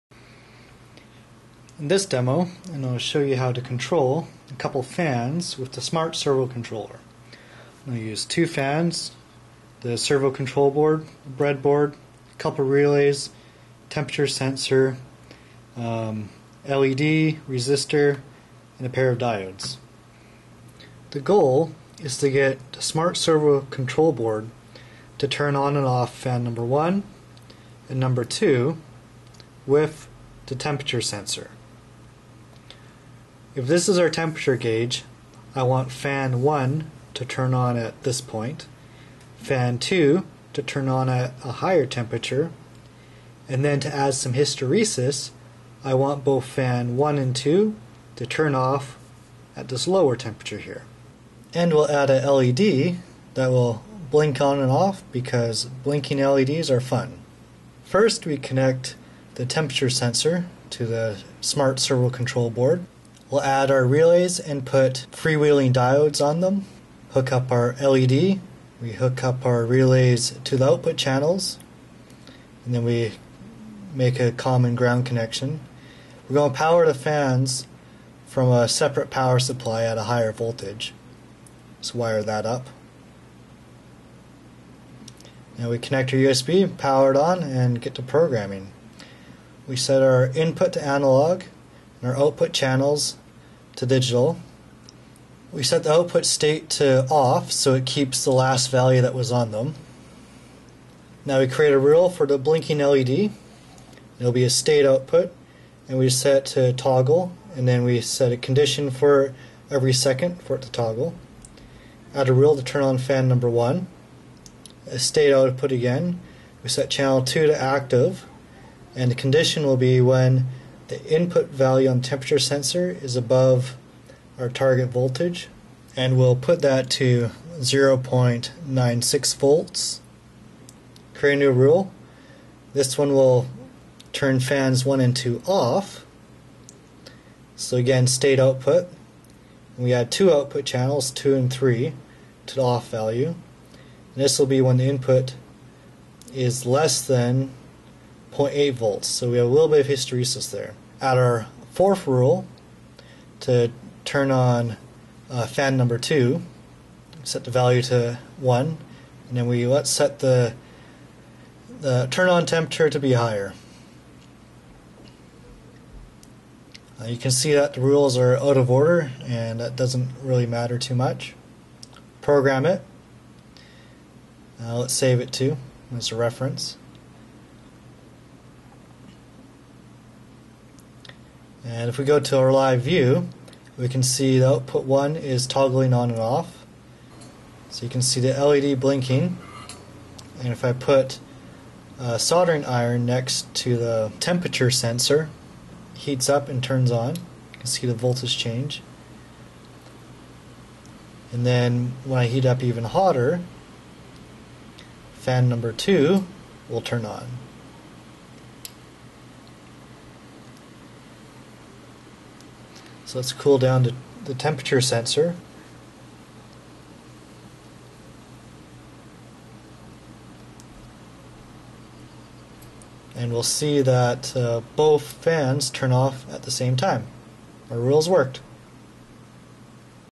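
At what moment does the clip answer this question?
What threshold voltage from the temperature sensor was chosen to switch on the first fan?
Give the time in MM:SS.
02:07.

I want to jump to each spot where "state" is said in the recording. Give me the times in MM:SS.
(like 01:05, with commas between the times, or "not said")
01:36, 01:44, 01:54, 02:18.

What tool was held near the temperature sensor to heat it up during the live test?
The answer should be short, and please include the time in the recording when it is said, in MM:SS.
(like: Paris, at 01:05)
soldering iron, at 03:12.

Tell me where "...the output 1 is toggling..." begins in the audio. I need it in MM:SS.
03:04.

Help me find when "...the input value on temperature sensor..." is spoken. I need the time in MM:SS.
02:00.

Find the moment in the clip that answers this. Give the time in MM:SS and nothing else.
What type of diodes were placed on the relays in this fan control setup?
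01:05.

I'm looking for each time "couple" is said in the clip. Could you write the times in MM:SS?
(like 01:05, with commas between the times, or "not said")
00:04, 00:12.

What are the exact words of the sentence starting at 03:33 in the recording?
So let's cool down to the temperature sensor.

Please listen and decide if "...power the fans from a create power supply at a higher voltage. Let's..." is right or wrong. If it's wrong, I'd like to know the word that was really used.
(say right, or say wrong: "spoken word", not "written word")
wrong: "separate", not "create".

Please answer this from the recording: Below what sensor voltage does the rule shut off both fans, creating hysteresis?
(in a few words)
0.8 volts.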